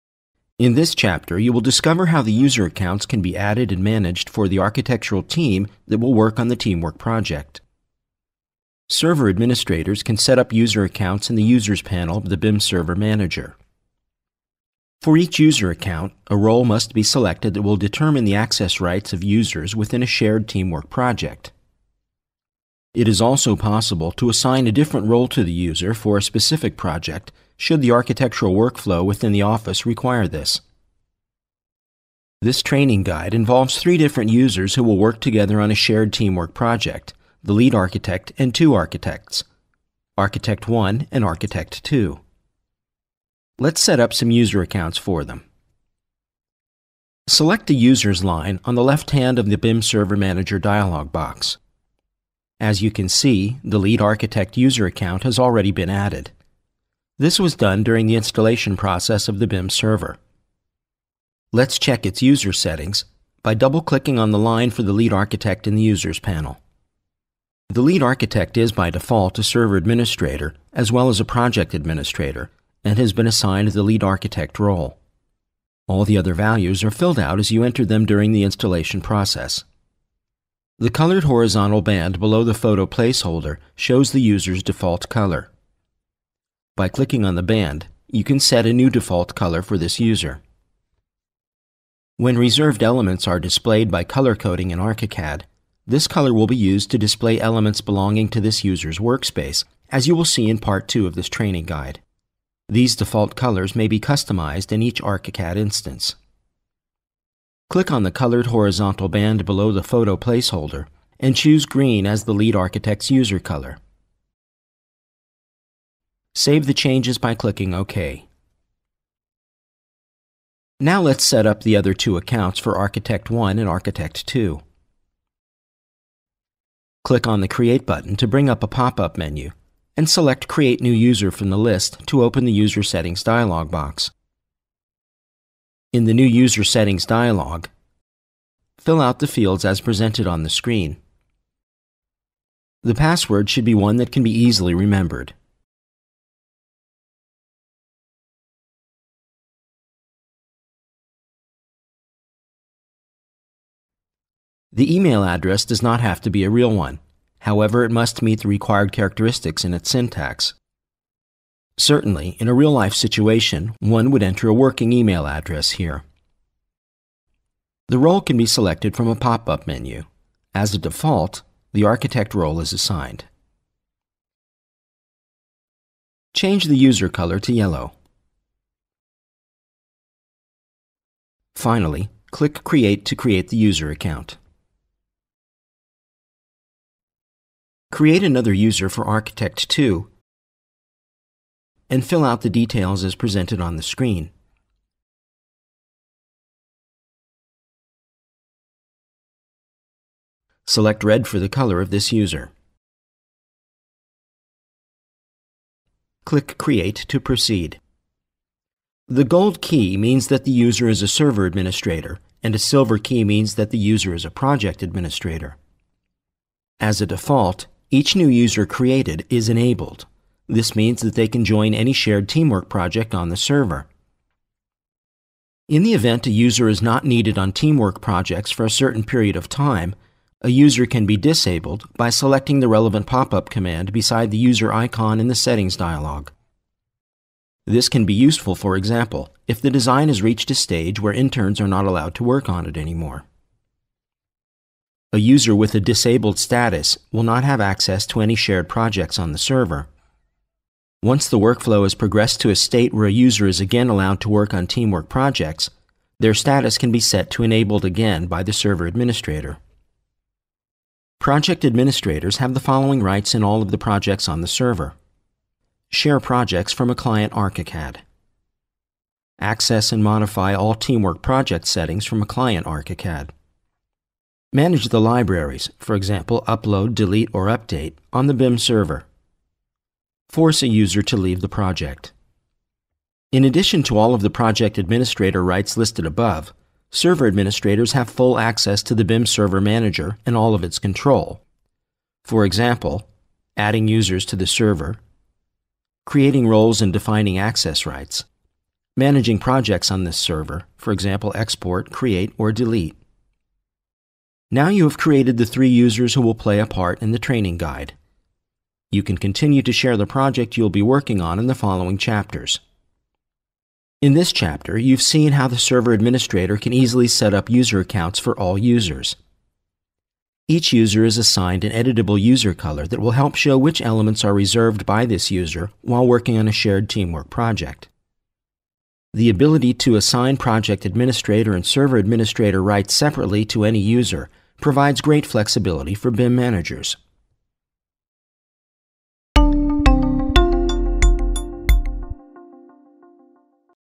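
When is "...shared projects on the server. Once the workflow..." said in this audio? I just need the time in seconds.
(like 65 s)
248 s.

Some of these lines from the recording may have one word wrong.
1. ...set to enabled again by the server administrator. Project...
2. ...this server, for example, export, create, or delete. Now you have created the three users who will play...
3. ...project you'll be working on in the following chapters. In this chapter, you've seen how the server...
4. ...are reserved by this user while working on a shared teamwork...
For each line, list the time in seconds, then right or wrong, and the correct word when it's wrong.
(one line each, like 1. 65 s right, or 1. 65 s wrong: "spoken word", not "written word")
1. 256 s right
2. 300 s right
3. 310 s right
4. 324 s right.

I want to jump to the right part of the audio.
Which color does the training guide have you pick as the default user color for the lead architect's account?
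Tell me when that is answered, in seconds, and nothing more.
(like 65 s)
111 s.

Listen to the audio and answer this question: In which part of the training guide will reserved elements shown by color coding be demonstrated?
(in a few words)
Part 2.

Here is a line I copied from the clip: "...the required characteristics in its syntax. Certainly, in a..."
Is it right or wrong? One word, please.
right.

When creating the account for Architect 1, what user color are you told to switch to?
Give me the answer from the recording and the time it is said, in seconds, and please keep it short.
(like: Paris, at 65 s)
Yellow, at 177 s.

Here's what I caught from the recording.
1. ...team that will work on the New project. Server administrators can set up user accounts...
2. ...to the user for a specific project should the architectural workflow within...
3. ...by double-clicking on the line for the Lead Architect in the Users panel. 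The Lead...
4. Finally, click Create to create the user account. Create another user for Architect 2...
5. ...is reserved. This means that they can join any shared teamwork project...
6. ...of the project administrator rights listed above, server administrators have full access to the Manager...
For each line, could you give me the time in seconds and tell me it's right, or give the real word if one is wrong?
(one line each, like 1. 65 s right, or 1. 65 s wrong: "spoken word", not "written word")
1. 5 s wrong: "Teamwork", not "New"
2. 25 s right
3. 63 s right
4. 181 s right
5. 219 s wrong: "enabled", not "reserved"
6. 284 s wrong: "BIM", not "Manager".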